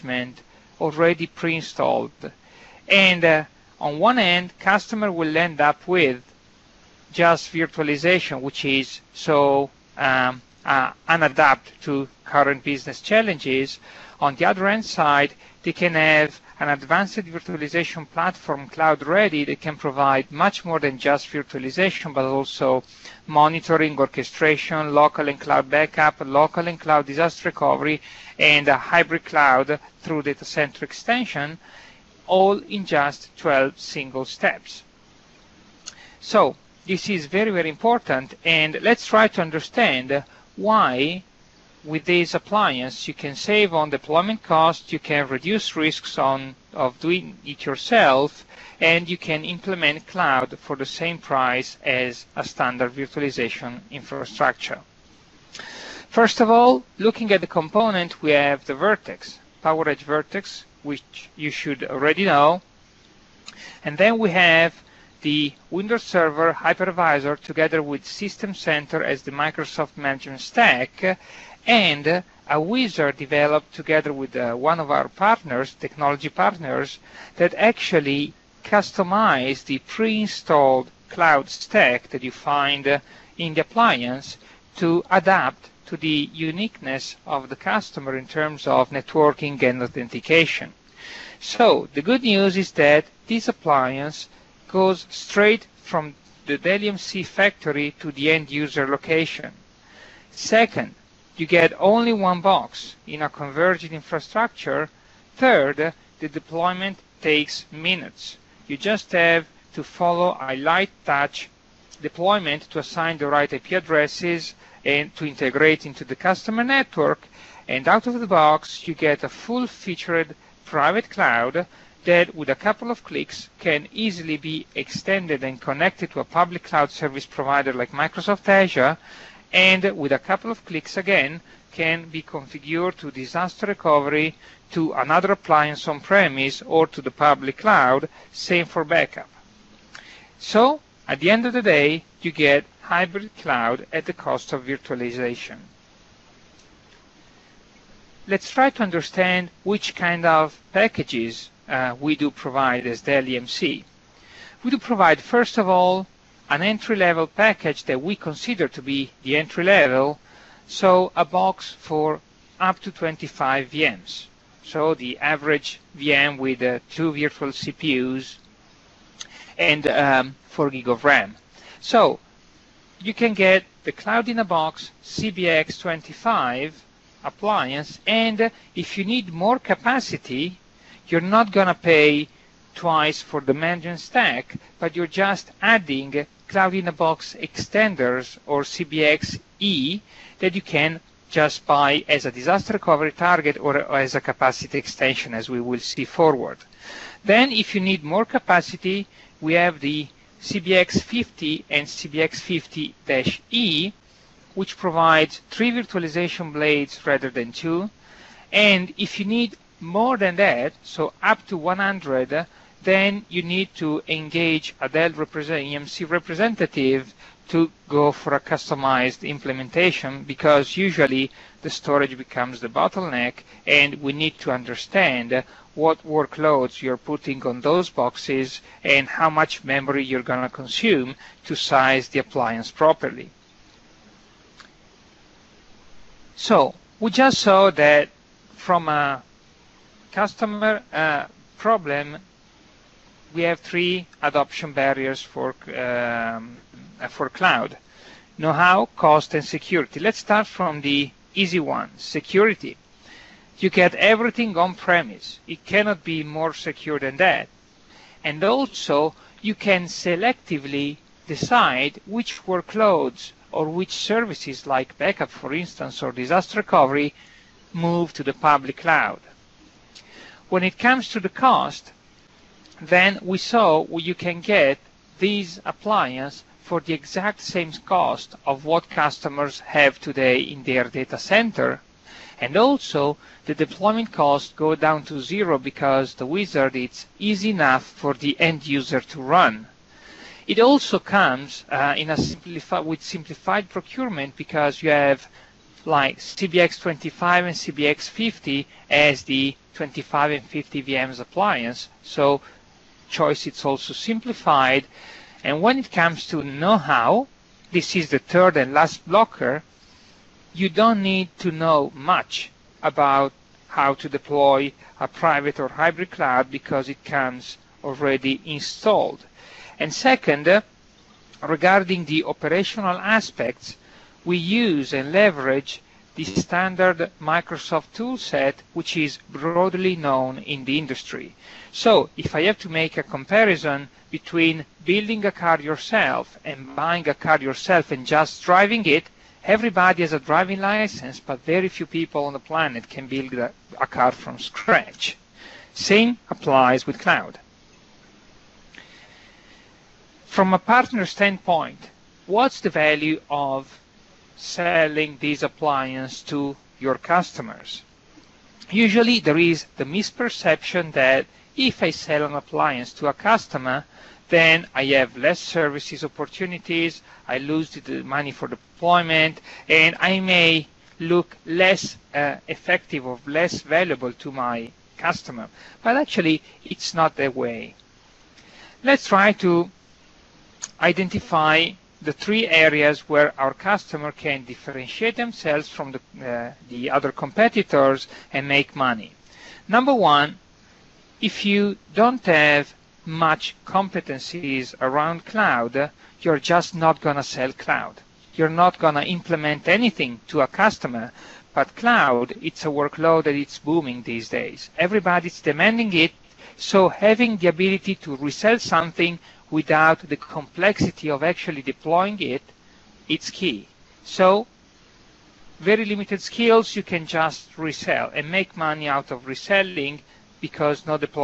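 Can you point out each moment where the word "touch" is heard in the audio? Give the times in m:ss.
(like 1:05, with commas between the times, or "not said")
1:51.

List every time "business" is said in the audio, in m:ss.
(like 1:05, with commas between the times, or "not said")
0:12.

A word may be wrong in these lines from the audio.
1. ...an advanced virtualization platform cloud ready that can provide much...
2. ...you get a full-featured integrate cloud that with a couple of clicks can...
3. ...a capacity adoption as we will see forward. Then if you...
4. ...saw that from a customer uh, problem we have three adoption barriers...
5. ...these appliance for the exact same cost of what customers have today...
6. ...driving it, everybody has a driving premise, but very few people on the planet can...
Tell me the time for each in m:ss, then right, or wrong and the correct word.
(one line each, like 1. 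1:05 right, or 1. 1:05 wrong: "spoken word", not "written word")
1. 0:16 right
2. 1:58 wrong: "private", not "integrate"
3. 3:14 wrong: "extension", not "adoption"
4. 3:57 right
5. 4:35 right
6. 5:38 wrong: "license", not "premise".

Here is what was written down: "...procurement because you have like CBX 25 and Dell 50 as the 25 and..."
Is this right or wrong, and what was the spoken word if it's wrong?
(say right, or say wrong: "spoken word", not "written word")
wrong: "CBX", not "Dell".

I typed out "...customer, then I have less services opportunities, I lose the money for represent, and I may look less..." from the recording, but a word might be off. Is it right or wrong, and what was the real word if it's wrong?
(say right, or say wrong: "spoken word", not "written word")
wrong: "deployment", not "represent".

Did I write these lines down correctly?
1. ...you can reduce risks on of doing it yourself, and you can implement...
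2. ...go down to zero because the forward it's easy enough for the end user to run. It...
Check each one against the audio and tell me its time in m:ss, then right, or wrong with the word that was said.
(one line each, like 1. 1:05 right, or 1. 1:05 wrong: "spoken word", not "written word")
1. 0:44 right
2. 4:44 wrong: "wizard", not "forward".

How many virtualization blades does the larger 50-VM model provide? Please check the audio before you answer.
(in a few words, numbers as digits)
3.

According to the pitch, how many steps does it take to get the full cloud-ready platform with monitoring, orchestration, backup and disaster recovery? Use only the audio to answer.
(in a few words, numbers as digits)
12.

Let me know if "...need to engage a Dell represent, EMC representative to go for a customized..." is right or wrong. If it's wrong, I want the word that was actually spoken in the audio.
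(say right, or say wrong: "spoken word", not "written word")
right.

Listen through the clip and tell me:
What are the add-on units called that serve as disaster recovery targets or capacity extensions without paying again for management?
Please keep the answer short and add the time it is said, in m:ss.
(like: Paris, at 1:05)
Cloud-in-a-Box extenders, at 3:06.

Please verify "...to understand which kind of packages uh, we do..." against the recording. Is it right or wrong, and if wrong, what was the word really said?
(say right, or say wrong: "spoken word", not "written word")
right.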